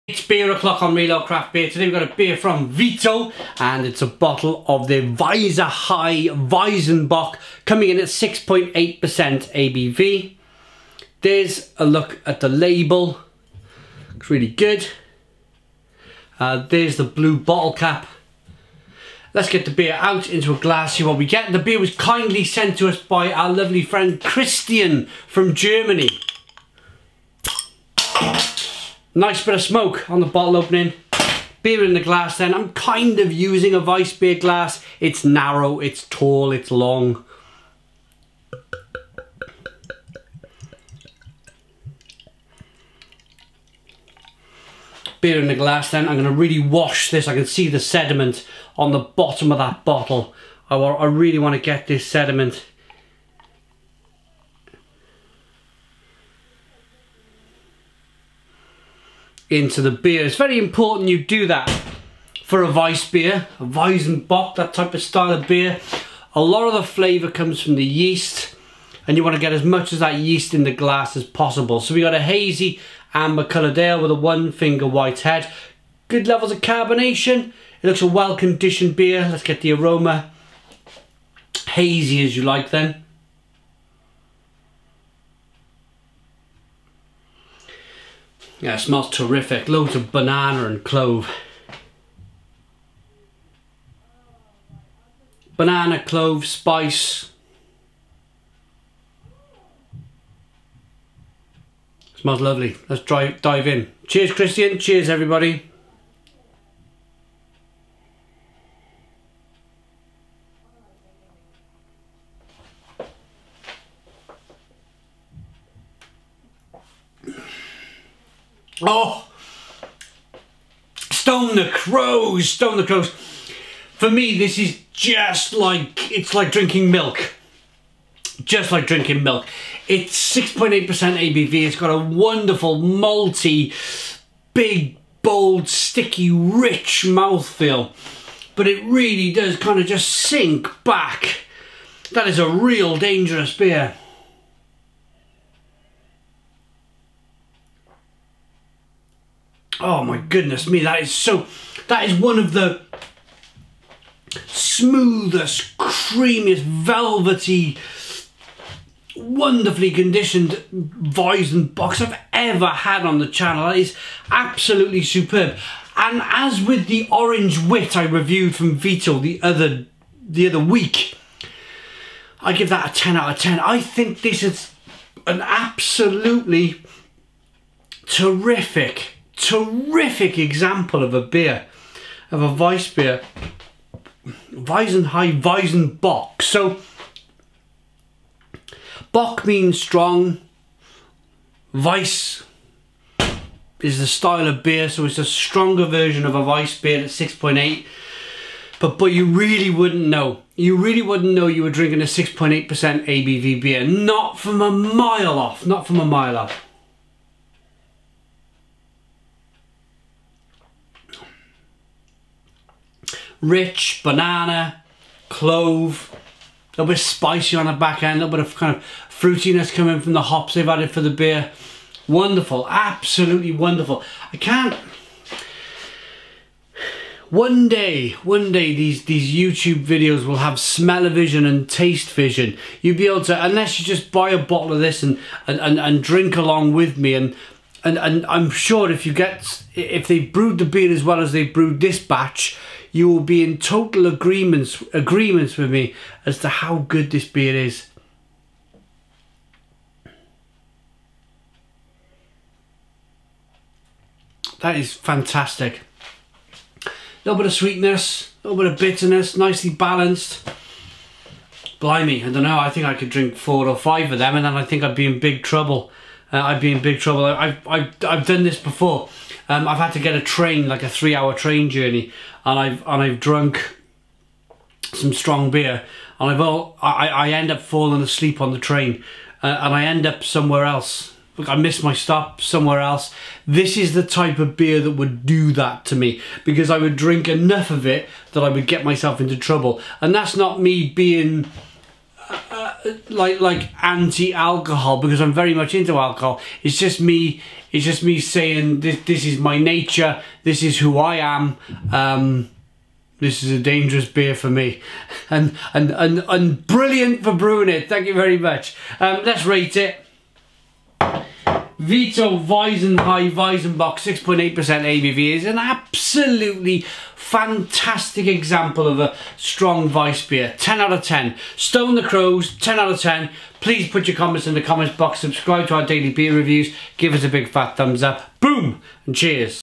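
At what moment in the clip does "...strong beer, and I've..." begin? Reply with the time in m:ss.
4:35.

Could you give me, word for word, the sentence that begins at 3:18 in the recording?
But, but you really wouldn't know.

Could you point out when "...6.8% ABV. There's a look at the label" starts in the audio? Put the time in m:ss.
0:08.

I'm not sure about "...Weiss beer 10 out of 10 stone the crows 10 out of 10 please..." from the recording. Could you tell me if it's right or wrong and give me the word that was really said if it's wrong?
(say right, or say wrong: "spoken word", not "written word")
right.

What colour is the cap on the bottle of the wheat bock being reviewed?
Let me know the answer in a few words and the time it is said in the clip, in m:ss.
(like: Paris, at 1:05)
Blue, at 0:17.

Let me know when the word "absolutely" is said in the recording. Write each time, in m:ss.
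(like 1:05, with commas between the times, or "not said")
2:44, 2:55, 3:42, 5:15.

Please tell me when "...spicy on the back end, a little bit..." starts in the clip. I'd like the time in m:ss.
3:36.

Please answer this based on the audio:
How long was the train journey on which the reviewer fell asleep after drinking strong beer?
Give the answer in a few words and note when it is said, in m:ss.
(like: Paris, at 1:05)
3 hours, at 4:30.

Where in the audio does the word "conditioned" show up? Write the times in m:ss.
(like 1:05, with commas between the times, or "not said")
1:18, 2:39.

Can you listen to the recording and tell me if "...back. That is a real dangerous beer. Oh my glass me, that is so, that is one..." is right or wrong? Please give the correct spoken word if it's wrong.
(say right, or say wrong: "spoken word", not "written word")
wrong: "goodness", not "glass".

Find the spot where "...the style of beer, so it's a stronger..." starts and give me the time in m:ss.
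3:13.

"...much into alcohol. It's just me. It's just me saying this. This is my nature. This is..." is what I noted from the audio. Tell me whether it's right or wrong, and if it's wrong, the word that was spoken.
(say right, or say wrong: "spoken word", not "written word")
right.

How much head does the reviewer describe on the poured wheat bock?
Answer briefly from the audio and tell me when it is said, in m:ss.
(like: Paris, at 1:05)
One finger, at 1:14.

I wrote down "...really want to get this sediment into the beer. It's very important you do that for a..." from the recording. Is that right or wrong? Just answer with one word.
right.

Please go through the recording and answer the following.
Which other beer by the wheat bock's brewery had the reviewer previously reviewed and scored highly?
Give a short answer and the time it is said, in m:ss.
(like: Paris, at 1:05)
Orange wit, at 2:47.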